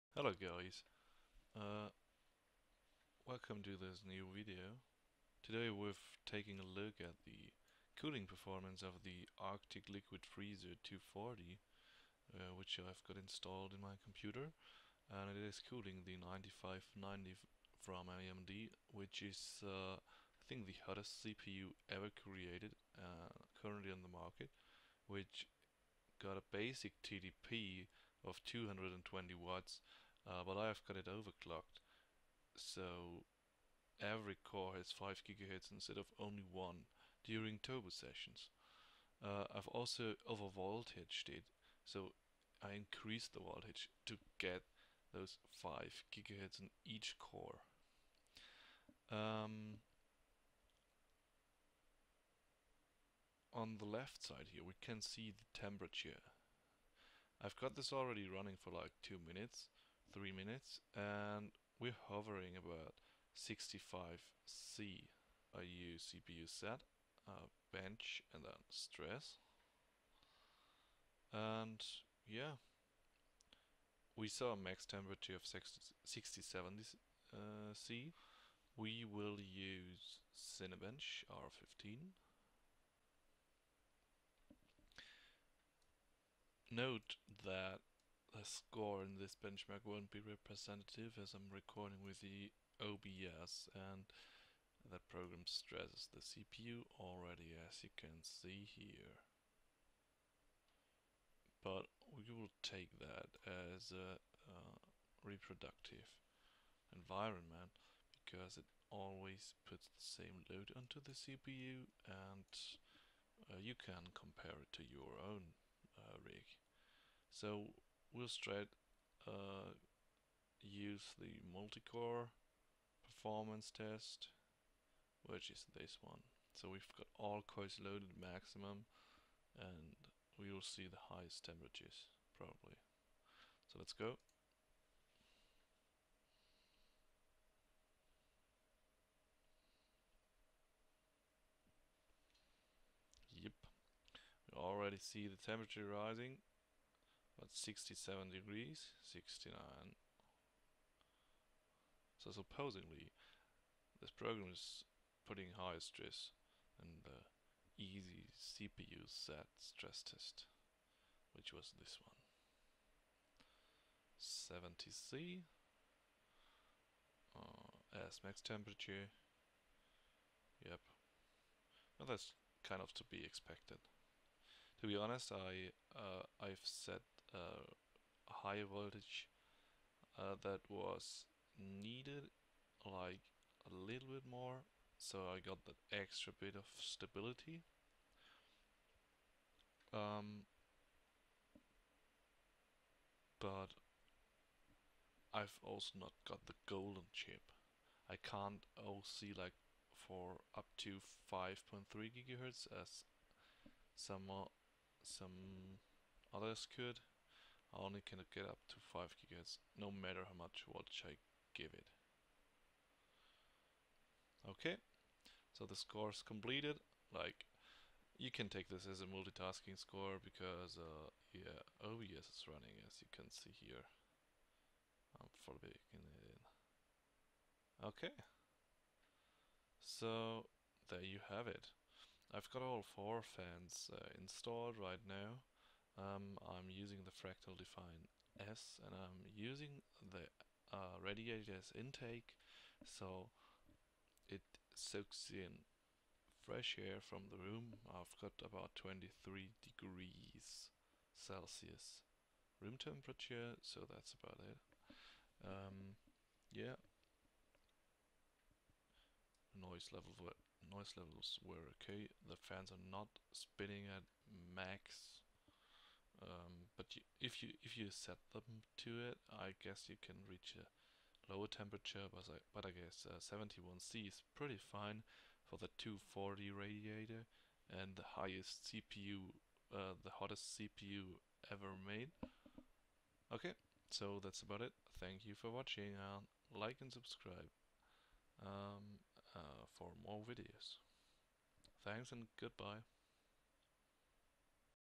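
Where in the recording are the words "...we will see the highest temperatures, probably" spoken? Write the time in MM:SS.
02:10.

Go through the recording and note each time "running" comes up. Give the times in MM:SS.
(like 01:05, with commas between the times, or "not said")
00:58, 03:42.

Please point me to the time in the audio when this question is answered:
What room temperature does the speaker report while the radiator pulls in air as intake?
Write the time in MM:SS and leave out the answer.
04:08.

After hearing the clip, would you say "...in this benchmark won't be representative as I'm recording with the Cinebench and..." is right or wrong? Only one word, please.
wrong.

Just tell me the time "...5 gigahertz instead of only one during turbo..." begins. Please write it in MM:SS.
00:34.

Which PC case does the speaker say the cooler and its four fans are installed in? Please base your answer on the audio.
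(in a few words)
Fractal Define S.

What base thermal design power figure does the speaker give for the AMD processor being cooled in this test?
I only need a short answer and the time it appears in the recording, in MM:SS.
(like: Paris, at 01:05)
220 watts, at 00:28.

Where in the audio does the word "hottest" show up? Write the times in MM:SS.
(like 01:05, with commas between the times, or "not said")
00:20, 04:40.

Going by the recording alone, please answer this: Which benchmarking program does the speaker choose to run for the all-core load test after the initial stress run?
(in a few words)
Cinebench R15.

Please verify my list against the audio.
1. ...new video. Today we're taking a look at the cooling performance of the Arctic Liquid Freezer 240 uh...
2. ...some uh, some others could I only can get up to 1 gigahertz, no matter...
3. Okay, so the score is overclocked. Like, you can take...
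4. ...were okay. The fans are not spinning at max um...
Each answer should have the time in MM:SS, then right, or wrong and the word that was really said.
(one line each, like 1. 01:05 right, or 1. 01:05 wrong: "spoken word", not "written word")
1. 00:04 right
2. 03:23 wrong: "5", not "1"
3. 03:34 wrong: "completed", not "overclocked"
4. 04:21 right.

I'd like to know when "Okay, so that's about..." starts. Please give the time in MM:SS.
04:43.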